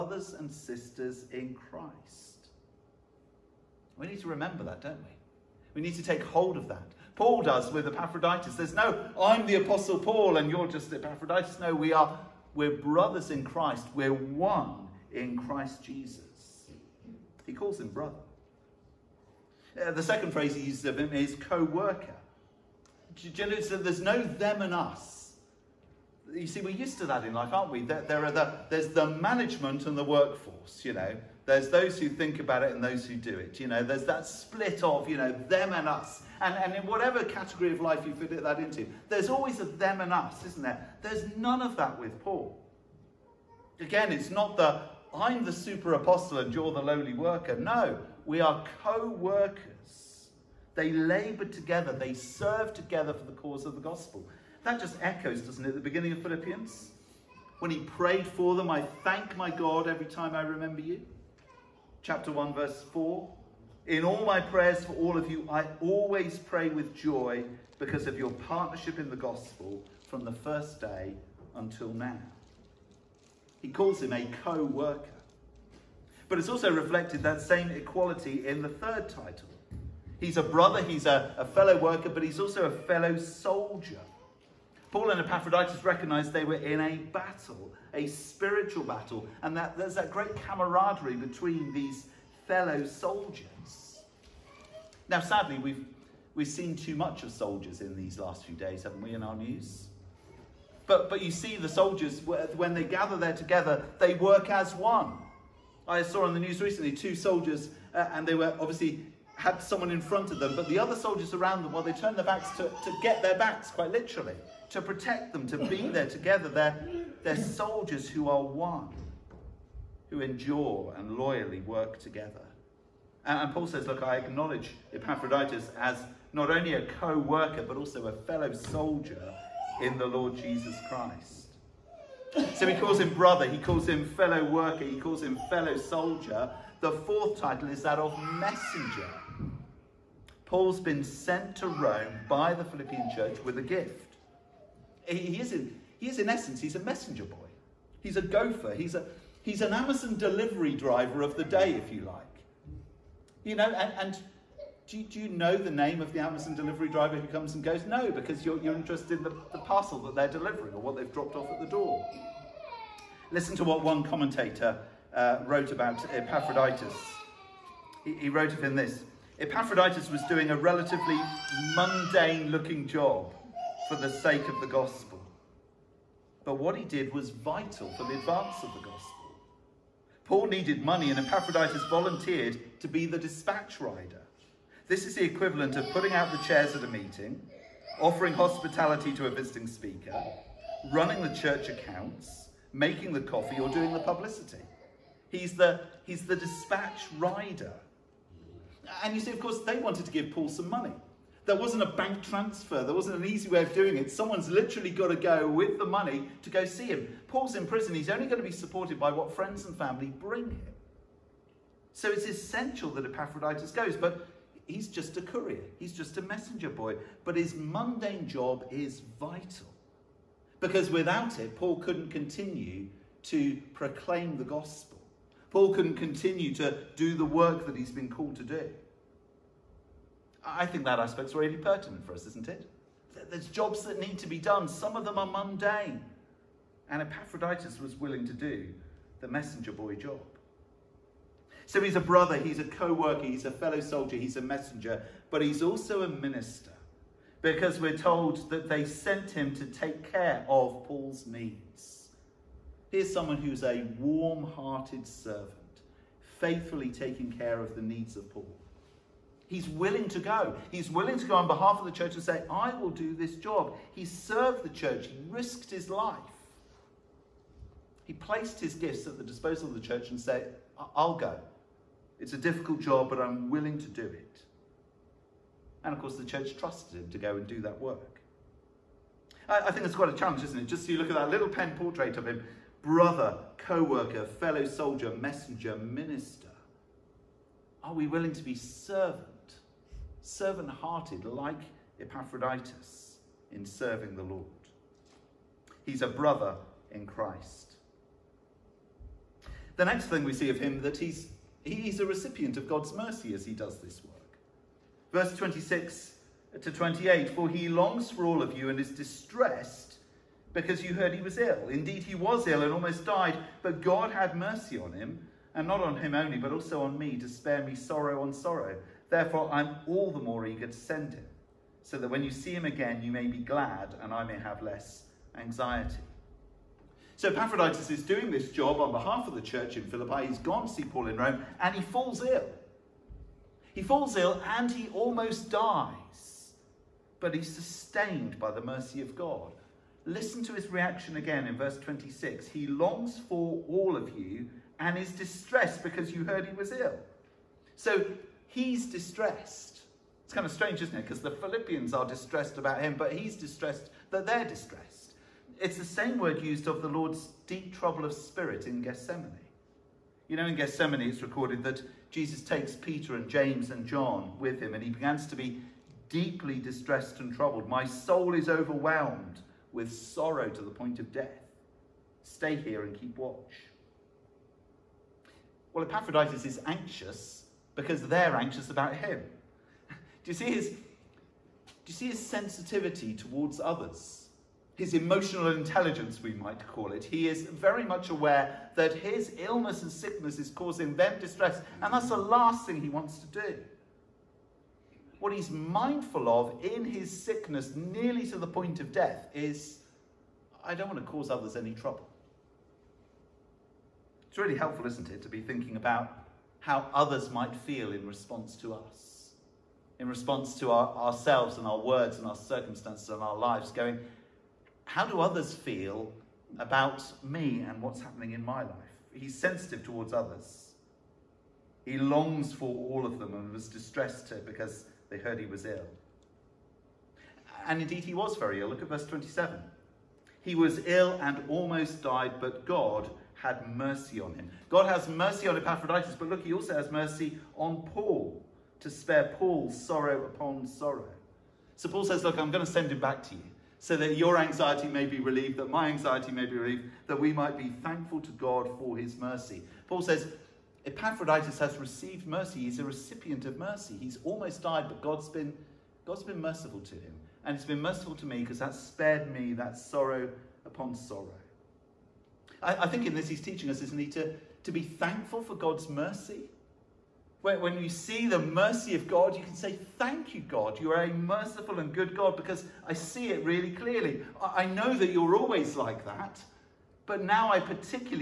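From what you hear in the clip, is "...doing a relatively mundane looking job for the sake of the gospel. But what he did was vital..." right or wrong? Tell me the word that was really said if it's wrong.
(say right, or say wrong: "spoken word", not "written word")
right.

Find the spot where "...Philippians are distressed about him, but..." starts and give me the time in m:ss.
5:51.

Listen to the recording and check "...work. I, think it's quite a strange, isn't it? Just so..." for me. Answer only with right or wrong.
wrong.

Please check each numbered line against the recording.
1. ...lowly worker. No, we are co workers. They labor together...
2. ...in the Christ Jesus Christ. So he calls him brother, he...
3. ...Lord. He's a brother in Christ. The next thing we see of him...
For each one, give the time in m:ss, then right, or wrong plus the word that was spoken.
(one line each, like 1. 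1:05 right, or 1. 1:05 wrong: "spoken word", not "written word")
1. 0:46 right
2. 2:09 wrong: "Lord", not "Christ"
3. 4:54 right.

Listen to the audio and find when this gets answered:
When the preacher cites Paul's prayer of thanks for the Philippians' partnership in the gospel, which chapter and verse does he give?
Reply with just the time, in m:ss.
1:02.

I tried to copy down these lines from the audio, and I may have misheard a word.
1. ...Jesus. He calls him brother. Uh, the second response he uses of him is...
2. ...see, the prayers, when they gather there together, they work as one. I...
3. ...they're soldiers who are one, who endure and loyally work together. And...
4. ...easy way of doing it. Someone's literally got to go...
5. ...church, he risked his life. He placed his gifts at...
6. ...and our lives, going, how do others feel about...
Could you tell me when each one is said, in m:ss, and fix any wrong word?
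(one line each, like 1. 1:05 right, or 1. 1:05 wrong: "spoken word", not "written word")
1. 0:15 wrong: "phrase", not "response"
2. 1:41 wrong: "soldiers", not "prayers"
3. 1:57 right
4. 3:23 right
5. 4:24 right
6. 6:53 right.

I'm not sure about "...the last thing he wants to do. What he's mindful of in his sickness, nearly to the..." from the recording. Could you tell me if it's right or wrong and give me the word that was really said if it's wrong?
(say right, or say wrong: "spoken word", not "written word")
right.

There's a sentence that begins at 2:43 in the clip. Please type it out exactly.
Listen to what one commentator uh, wrote about Epaphroditus.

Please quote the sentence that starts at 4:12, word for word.
Here's someone who's a warm hearted servant, faithfully taking care of the needs of Paul.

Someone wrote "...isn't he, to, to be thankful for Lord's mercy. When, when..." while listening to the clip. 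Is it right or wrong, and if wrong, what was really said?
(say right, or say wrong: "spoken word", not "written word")
wrong: "God", not "Lord".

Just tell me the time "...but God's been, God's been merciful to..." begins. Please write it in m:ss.
7:34.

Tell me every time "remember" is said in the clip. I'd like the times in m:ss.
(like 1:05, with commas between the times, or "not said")
0:04, 1:00.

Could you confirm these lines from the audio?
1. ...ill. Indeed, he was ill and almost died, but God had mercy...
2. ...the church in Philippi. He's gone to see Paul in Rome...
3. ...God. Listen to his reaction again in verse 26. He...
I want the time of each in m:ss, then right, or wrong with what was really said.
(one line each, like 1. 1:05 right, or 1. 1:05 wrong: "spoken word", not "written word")
1. 5:11 right
2. 5:29 right
3. 5:39 right.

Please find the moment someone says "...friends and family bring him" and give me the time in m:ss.
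3:29.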